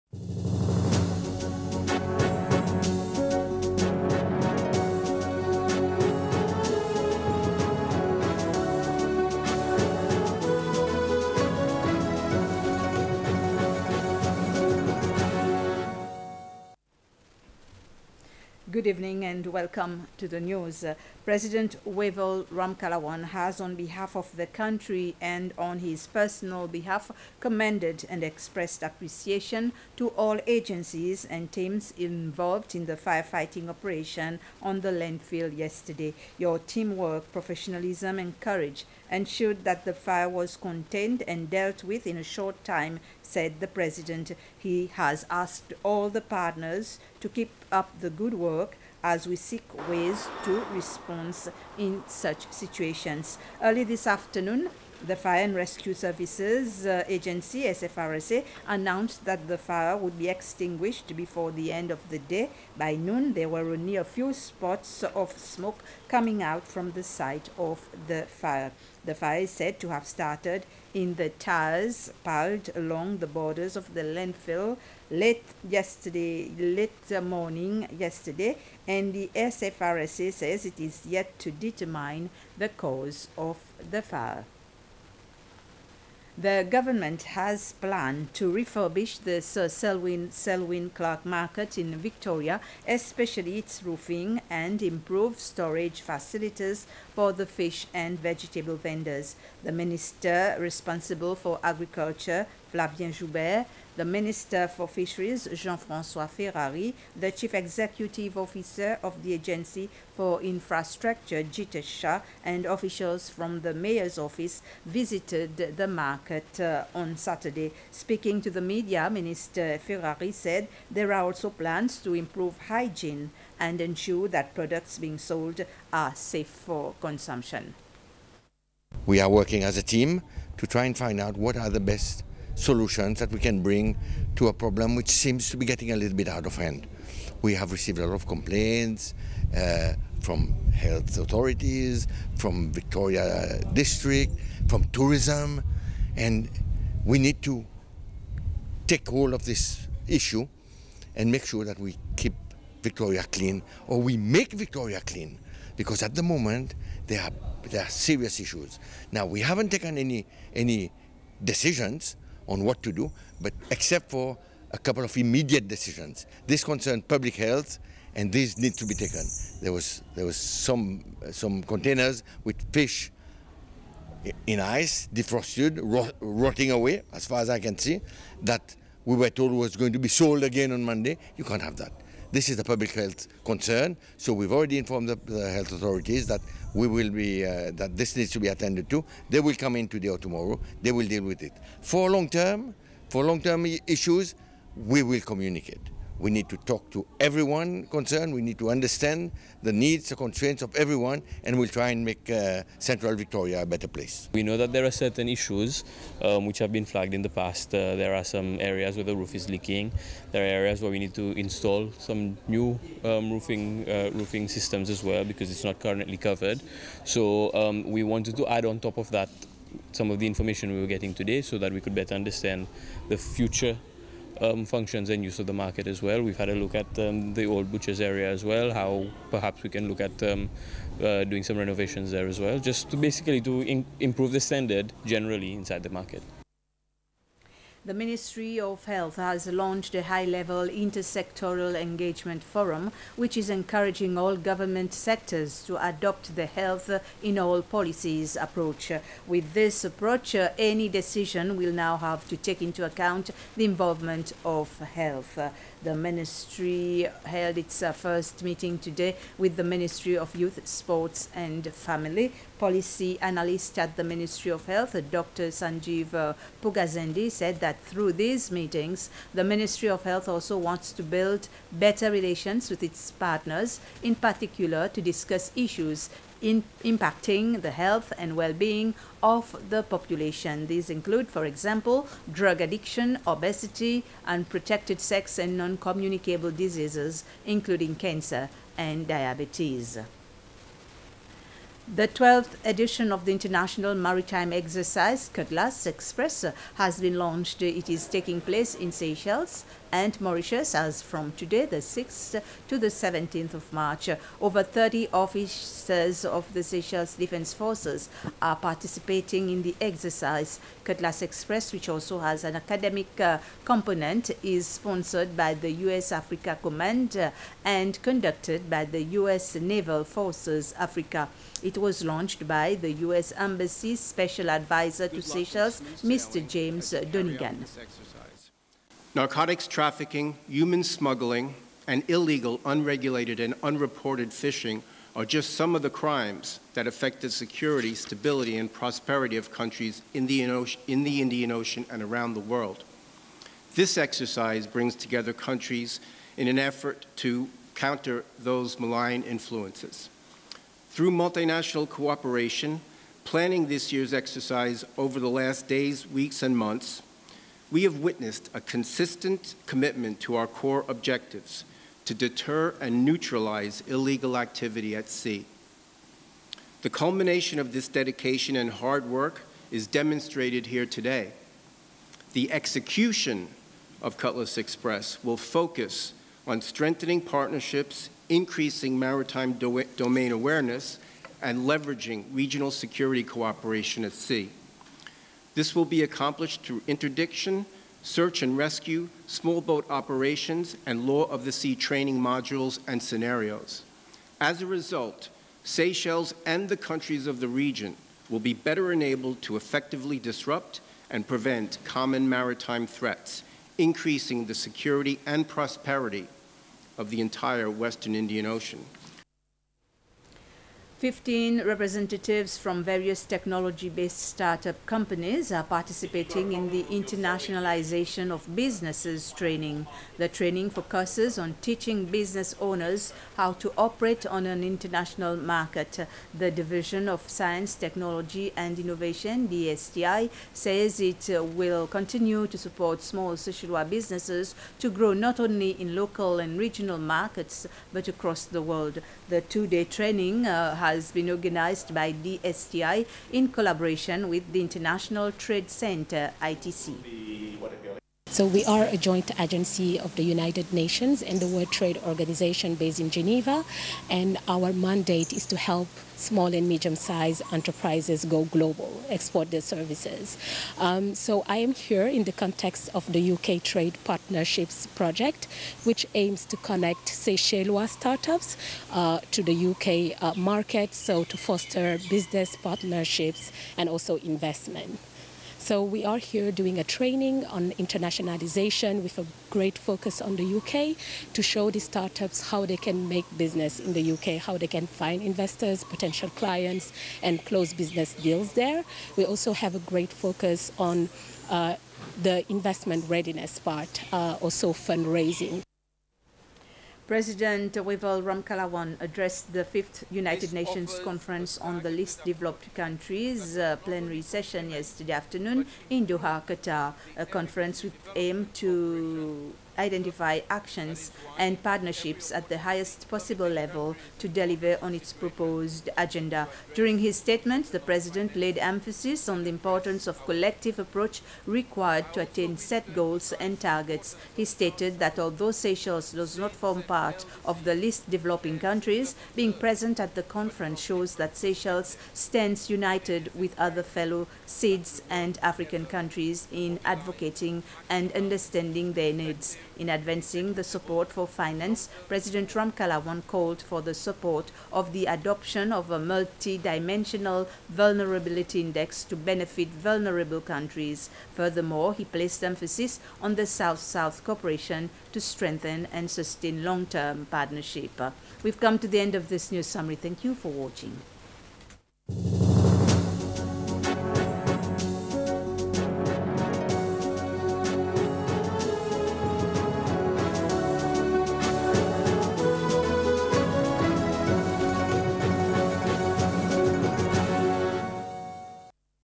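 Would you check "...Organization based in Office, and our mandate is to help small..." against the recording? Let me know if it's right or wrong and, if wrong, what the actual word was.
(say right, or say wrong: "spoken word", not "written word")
wrong: "Geneva", not "Office".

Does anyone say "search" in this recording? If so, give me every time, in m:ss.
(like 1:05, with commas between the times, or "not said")
6:28.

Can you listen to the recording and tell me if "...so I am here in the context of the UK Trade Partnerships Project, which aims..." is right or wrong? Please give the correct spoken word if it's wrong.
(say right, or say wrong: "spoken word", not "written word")
right.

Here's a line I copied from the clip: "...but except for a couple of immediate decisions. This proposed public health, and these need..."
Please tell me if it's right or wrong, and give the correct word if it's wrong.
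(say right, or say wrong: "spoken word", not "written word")
wrong: "concerned", not "proposed".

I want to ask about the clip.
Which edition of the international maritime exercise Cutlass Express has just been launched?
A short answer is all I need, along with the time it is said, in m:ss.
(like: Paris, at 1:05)
12th, at 4:52.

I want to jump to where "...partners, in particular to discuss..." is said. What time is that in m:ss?
4:33.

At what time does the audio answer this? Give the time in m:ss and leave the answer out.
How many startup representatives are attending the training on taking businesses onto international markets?
6:51.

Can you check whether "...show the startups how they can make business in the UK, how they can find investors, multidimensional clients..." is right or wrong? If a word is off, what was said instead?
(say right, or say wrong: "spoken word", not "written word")
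wrong: "potential", not "multidimensional".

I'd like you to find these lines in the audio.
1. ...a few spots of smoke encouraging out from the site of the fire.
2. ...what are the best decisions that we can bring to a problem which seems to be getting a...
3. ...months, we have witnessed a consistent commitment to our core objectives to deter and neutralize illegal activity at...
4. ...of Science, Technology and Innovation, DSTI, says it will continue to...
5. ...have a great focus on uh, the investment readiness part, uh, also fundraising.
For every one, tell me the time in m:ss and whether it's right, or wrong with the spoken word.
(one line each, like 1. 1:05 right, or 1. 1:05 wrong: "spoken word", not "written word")
1. 1:03 wrong: "coming", not "encouraging"
2. 2:11 wrong: "solutions", not "decisions"
3. 5:56 right
4. 7:07 right
5. 8:09 right.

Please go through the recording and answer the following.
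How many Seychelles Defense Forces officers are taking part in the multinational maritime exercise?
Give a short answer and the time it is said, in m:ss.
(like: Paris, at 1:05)
Over 30, at 5:04.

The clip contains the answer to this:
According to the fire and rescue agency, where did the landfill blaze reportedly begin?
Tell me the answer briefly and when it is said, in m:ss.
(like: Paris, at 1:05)
Towers piled along the borders, at 1:11.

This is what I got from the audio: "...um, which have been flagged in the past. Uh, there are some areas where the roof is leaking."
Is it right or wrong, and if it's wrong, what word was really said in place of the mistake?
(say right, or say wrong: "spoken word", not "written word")
right.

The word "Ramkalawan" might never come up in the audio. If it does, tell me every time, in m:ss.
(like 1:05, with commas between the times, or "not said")
0:22, 8:18, 9:02.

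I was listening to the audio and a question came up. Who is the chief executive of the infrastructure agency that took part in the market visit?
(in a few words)
Jitter Shah.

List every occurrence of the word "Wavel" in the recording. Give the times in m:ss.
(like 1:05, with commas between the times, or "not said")
0:21, 8:17.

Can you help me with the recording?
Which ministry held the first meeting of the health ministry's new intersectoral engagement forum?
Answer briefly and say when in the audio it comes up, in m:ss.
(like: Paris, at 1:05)
Ministry of Youth, Sports and Family, at 4:19.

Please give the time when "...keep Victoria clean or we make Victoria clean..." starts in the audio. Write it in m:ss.
2:32.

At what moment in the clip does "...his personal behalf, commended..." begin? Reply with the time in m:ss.
0:25.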